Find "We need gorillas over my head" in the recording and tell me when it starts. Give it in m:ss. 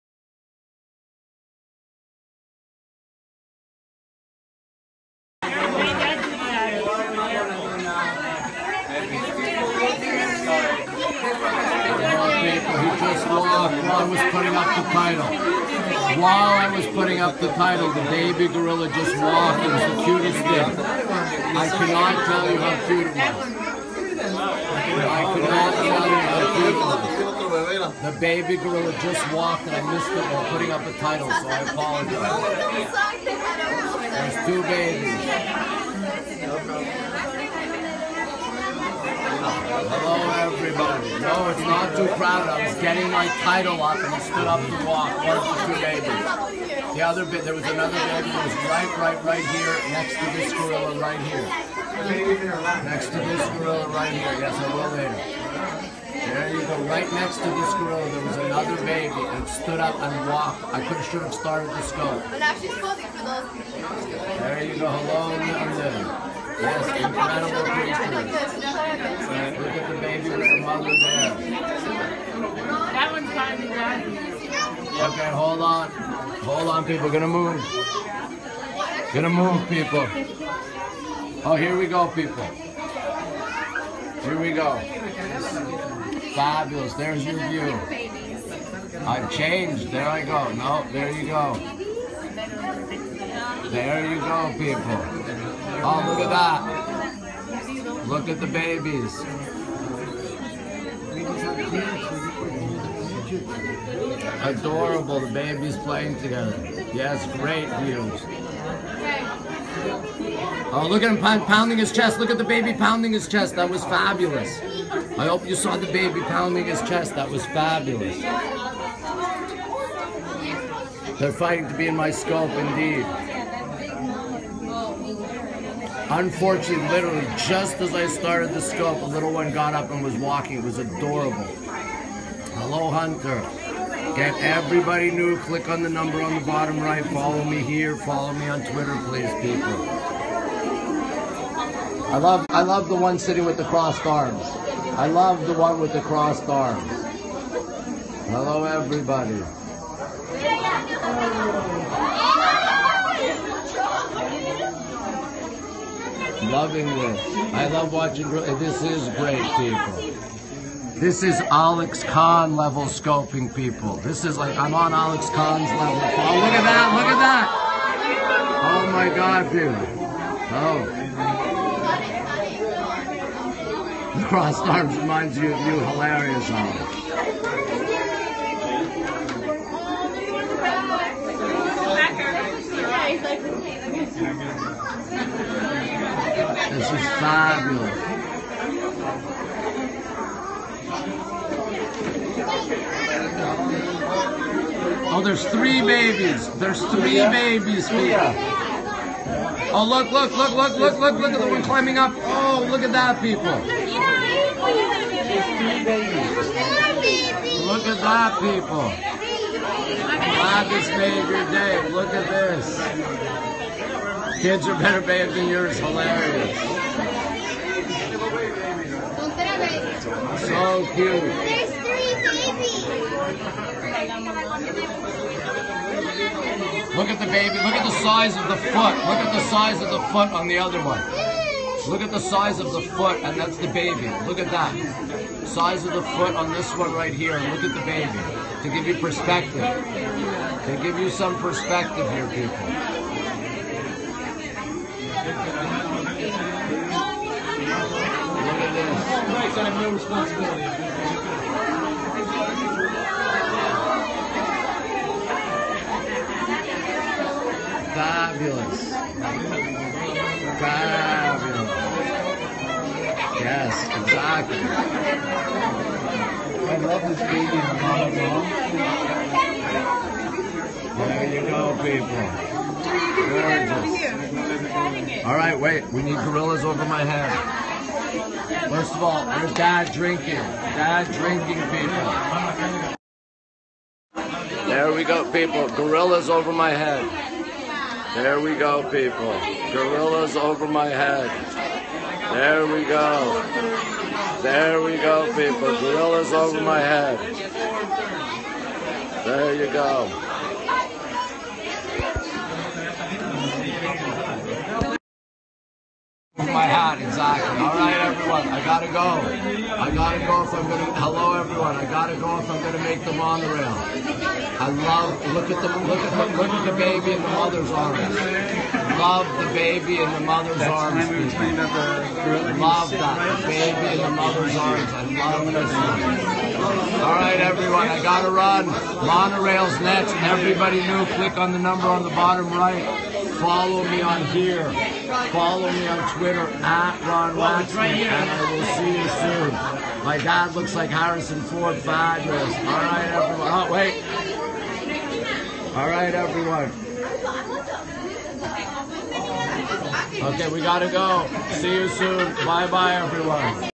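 4:35.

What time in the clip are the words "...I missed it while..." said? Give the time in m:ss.
0:29.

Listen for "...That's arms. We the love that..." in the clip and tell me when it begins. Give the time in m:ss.
5:20.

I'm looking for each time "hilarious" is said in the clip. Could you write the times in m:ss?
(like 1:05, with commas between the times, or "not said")
2:55, 3:35.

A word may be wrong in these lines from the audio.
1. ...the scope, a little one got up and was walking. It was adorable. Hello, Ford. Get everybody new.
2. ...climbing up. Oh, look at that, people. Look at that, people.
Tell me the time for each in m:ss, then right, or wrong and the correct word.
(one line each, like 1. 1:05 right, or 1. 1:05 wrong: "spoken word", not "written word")
1. 2:08 wrong: "Hunter", not "Ford"
2. 3:21 right.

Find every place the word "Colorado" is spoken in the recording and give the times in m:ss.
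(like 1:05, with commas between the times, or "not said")
not said.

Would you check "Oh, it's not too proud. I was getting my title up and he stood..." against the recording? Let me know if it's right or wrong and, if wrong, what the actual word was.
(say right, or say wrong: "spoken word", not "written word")
right.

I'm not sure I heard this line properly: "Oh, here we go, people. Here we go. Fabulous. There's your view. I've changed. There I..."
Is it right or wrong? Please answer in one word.
right.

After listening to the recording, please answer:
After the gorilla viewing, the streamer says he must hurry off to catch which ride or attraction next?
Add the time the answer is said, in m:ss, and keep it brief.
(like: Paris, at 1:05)
the monorail, at 5:12.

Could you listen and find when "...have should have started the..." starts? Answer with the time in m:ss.
1:00.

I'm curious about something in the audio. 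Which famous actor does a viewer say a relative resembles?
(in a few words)
Harrison Ford.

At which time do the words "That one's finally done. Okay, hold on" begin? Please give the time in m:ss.
1:12.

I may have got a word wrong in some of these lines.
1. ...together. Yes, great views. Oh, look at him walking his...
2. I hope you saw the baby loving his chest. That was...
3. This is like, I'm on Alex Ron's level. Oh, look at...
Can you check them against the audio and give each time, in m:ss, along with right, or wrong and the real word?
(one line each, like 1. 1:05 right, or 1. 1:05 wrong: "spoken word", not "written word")
1. 1:46 wrong: "pounding", not "walking"
2. 1:55 wrong: "pounding", not "loving"
3. 2:43 wrong: "Khan", not "Ron".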